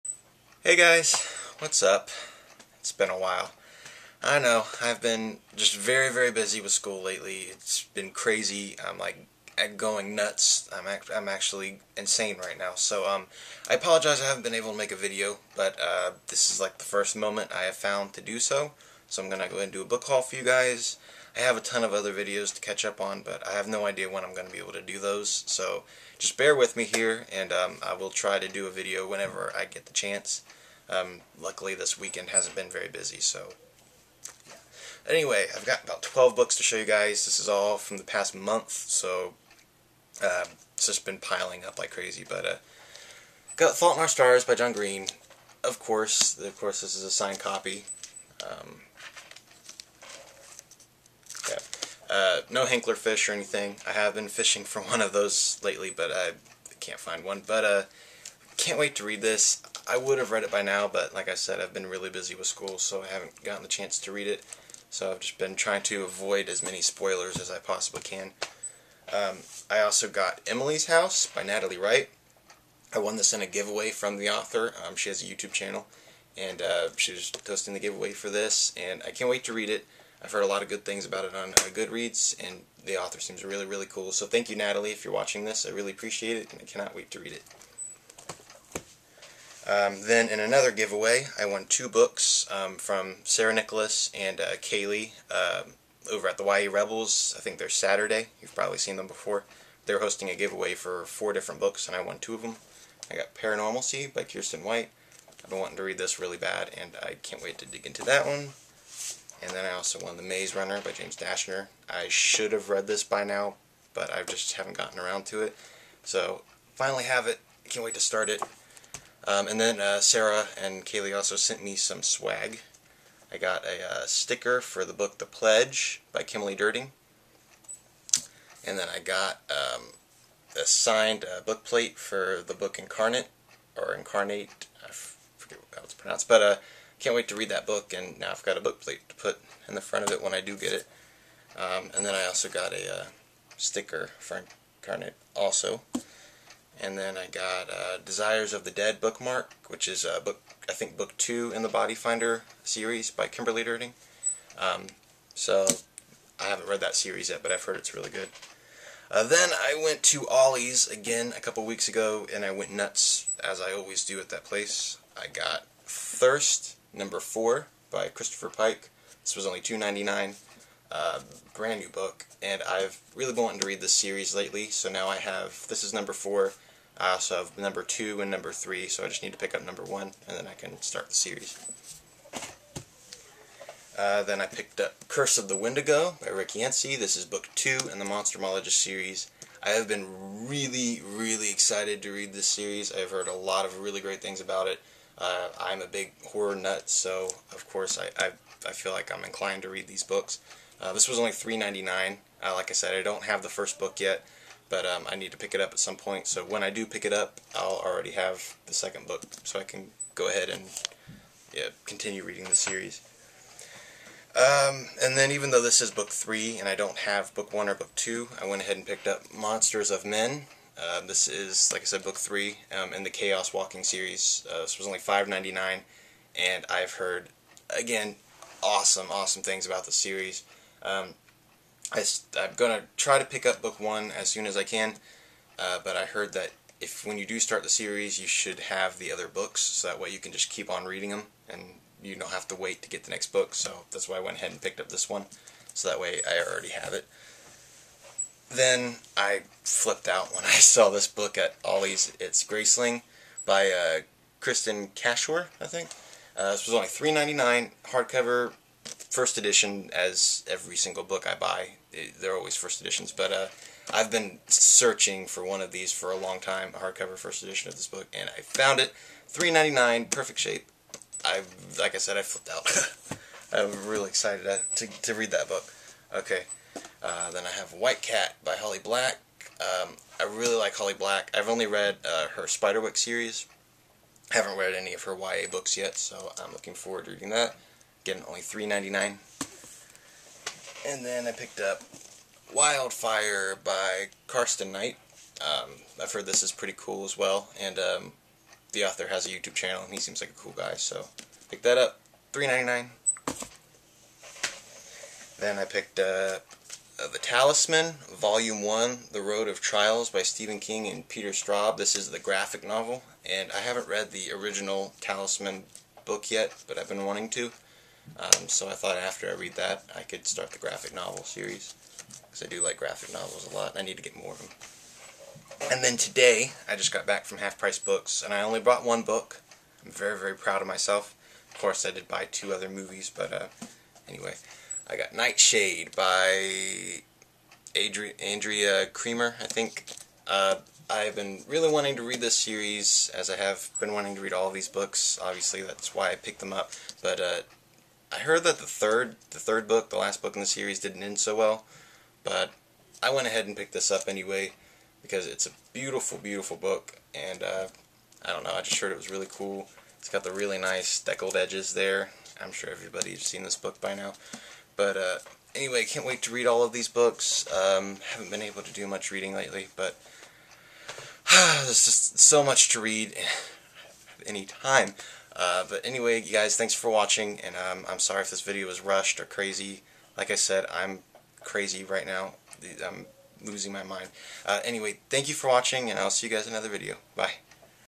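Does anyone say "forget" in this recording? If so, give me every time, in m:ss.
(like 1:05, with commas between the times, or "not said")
2:14.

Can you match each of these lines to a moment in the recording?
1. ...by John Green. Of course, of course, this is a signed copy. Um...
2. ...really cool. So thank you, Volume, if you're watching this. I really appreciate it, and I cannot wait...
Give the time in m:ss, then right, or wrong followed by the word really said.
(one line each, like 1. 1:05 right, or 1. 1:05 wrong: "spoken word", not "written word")
1. 0:44 right
2. 1:23 wrong: "Natalie", not "Volume".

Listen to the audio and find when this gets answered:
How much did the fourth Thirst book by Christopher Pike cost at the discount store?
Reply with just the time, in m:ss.
2:49.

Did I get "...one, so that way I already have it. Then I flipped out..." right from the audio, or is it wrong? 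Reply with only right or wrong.
right.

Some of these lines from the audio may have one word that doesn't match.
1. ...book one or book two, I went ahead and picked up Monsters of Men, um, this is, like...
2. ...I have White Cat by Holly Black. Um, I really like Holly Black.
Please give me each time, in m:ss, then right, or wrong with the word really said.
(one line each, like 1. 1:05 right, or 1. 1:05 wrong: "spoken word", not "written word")
1. 3:37 right
2. 4:37 right.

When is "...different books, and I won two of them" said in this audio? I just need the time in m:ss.
1:41.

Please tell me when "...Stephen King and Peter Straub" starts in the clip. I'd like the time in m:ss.
5:10.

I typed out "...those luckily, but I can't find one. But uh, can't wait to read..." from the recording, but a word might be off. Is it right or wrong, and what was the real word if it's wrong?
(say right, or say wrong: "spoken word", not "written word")
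wrong: "lately", not "luckily".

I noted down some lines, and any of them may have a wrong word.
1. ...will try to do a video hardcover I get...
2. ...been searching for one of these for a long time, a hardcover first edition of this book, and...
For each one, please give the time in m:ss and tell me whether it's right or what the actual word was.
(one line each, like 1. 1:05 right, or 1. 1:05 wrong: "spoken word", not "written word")
1. 0:27 wrong: "whenever", not "hardcover"
2. 4:24 right.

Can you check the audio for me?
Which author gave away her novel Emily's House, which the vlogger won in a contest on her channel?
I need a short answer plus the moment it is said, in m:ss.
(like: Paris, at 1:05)
Natalie Wright, at 1:11.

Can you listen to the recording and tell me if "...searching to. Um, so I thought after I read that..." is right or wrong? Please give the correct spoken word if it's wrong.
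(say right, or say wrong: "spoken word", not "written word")
wrong: "wanting", not "searching".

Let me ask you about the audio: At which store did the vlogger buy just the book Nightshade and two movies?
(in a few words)
Half Price Books.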